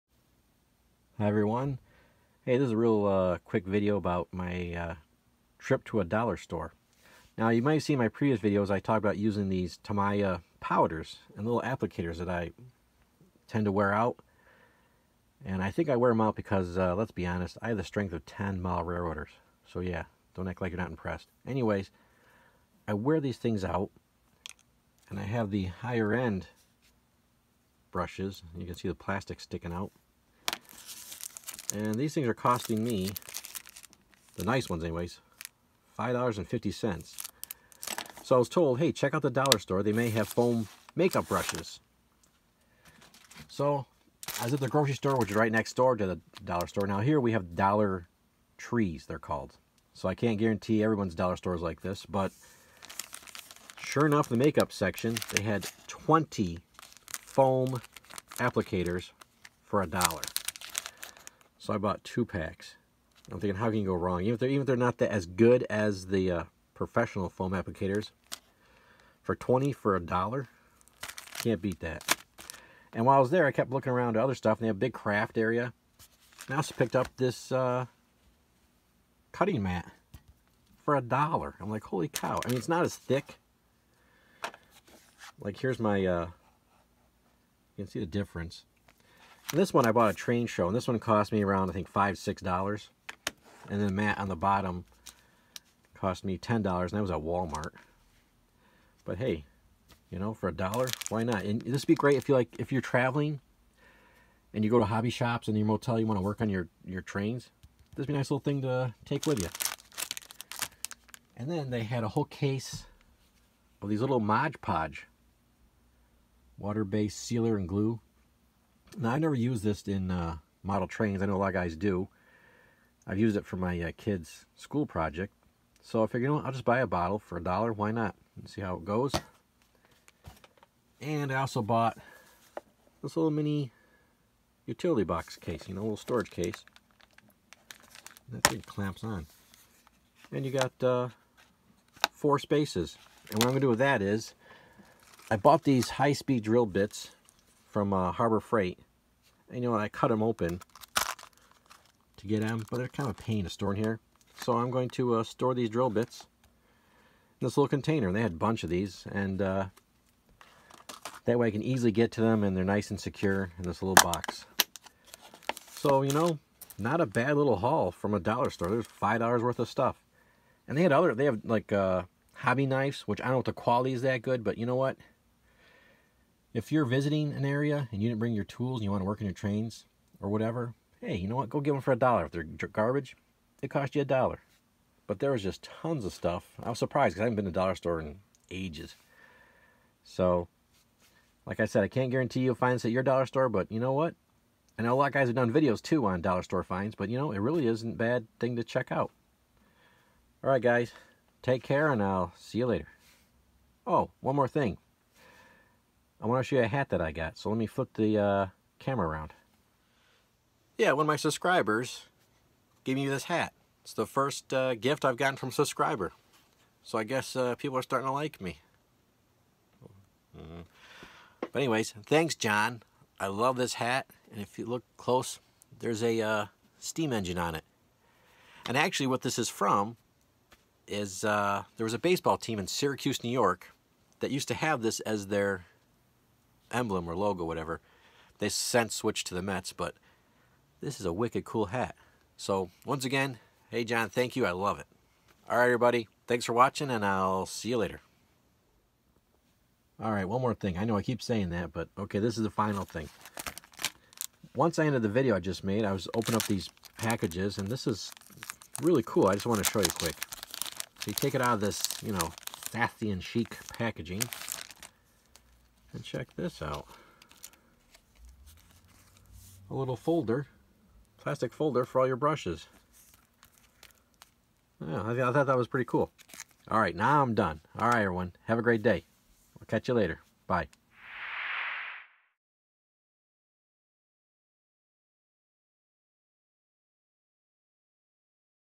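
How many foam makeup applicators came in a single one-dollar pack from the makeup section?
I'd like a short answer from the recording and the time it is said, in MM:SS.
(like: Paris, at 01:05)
20, at 00:55.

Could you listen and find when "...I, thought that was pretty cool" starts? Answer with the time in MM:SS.
04:35.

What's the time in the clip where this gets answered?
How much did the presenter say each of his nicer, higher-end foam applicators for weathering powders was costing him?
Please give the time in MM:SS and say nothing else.
00:35.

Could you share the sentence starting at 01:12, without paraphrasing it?
And while I was there, I kept looking around to other stuff, and they have a big craft area.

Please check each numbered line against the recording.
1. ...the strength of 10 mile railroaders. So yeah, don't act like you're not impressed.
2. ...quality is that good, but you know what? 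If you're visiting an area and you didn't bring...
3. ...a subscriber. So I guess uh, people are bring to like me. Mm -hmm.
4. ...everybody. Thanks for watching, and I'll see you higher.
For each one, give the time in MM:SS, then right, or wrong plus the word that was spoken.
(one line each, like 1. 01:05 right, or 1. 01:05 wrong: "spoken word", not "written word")
1. 00:17 right
2. 02:53 right
3. 03:35 wrong: "starting", not "bring"
4. 04:05 wrong: "later", not "higher".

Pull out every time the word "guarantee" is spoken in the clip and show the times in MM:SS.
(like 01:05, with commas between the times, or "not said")
00:50, 03:12.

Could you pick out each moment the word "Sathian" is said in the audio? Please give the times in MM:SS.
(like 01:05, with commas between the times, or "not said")
04:22.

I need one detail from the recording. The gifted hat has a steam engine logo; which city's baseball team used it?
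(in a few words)
Syracuse.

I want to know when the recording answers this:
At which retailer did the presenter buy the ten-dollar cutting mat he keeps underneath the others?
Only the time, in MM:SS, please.
01:37.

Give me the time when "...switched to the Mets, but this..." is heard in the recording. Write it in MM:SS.
03:58.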